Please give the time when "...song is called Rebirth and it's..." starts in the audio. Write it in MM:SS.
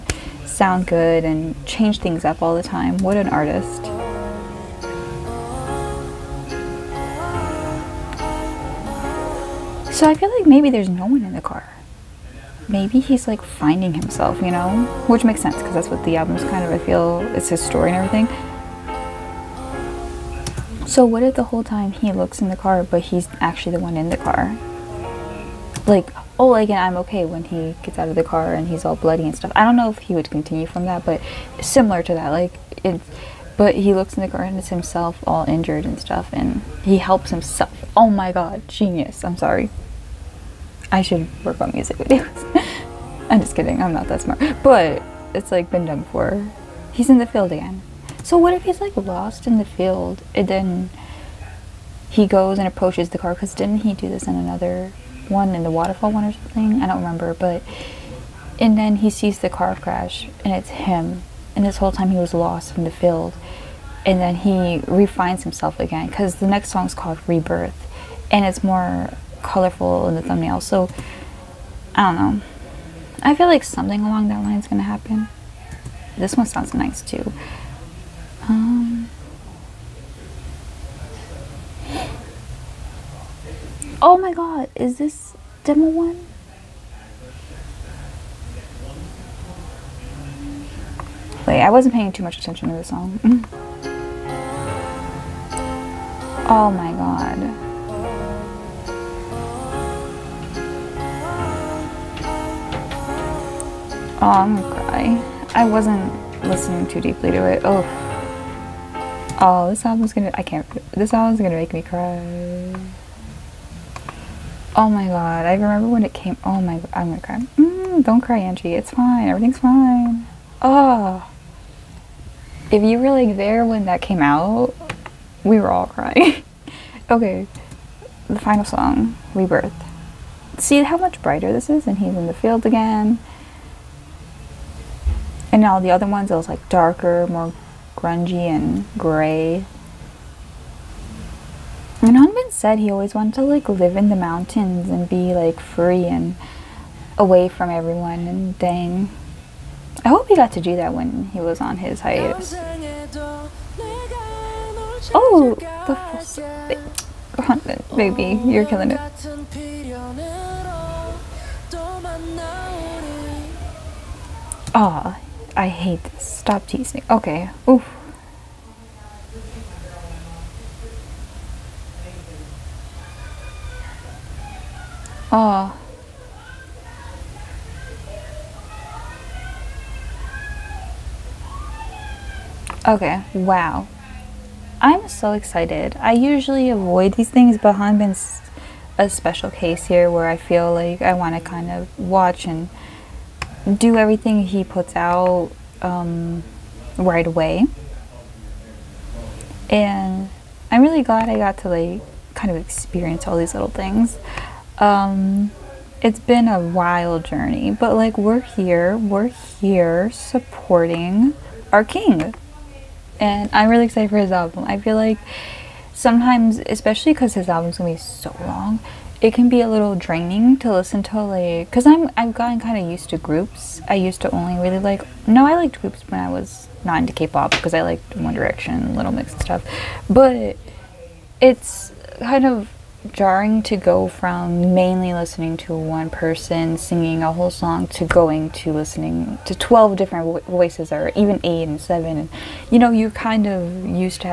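01:06.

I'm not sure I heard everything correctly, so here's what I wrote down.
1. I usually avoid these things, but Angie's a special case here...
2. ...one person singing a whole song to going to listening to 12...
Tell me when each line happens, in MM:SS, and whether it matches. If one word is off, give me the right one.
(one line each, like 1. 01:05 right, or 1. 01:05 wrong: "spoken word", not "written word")
1. 03:05 wrong: "Hanbin", not "Angie"
2. 03:55 right.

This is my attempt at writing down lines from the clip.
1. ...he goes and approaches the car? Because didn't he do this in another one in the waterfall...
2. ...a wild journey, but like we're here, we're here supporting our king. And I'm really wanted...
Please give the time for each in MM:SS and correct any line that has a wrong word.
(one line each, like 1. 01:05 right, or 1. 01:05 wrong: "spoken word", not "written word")
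1. 00:52 right
2. 03:26 wrong: "excited", not "wanted".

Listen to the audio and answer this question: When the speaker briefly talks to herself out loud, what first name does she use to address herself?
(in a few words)
Angie.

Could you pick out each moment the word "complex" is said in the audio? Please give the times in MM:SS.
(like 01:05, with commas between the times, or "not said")
not said.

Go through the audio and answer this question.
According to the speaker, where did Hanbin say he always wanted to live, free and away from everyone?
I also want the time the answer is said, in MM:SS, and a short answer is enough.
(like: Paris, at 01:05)
the mountains, at 02:24.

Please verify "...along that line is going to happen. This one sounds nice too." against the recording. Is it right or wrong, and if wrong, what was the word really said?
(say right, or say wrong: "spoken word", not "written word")
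right.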